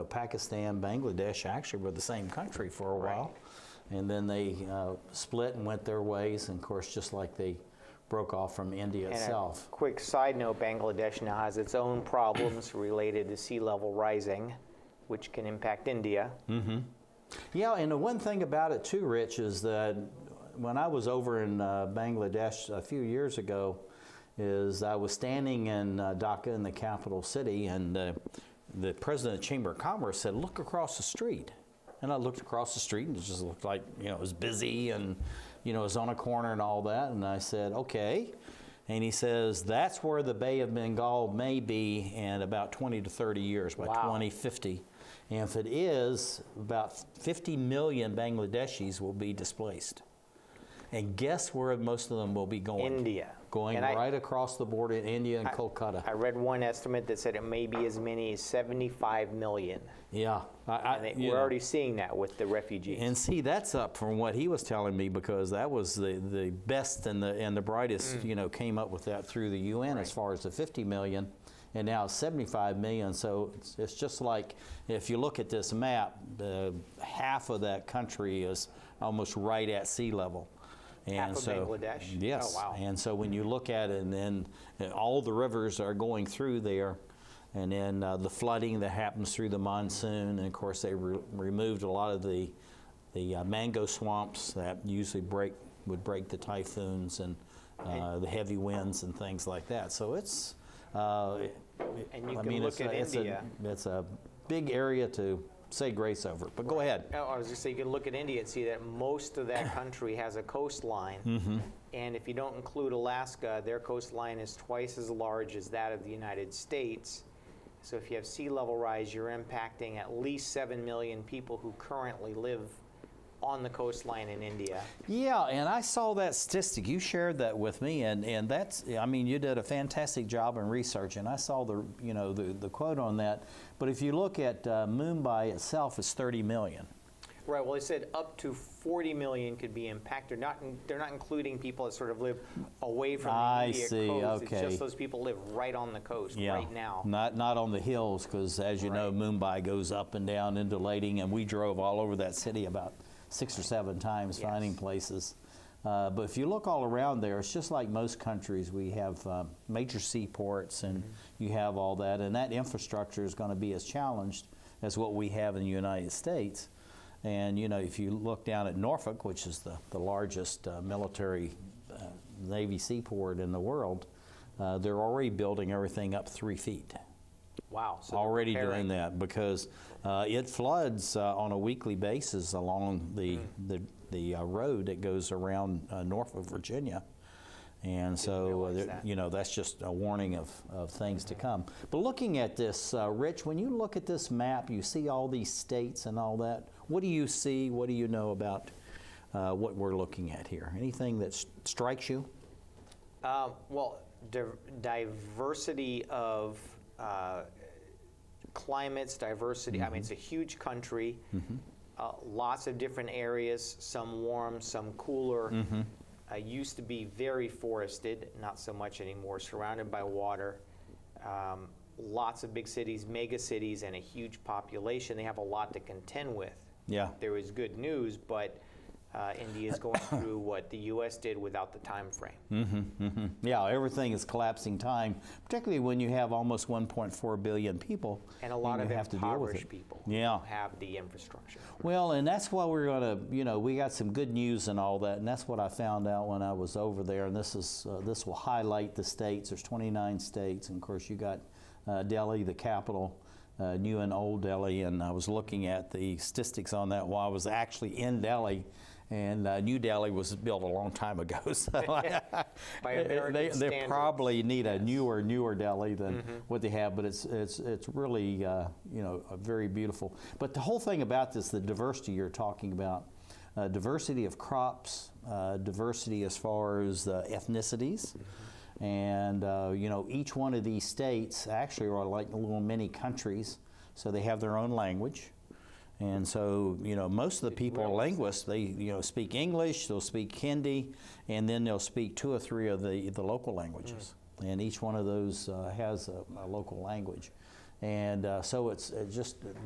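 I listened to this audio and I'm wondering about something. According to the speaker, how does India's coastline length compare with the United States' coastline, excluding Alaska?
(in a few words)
twice as large.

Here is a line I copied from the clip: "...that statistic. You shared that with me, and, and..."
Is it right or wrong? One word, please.
right.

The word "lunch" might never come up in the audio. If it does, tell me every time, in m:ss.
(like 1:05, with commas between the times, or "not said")
not said.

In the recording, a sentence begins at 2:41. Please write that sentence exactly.
you have all that, and that infrastructure is going to be as challenged as what we have in the United States.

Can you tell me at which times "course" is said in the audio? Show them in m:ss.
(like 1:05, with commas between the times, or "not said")
0:06, 1:30, 4:10.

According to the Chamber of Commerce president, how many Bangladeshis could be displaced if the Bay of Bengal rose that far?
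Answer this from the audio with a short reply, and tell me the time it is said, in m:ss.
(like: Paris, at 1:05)
50 million, at 0:46.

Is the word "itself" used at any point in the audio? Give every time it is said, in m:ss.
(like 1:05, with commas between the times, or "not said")
0:09, 2:15.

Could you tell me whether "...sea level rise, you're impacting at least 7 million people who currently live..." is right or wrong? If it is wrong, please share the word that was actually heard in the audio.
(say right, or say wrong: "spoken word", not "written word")
right.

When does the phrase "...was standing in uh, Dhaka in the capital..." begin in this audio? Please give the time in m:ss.
0:24.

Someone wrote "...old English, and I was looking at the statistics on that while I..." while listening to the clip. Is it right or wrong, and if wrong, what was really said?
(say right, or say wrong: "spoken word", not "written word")
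wrong: "Delhi", not "English".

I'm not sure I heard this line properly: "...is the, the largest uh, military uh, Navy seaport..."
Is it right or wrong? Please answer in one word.
right.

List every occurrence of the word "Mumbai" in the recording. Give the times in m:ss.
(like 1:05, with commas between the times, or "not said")
2:14, 2:29.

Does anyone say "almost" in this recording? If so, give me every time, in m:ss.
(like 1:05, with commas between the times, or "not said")
1:19, 3:56.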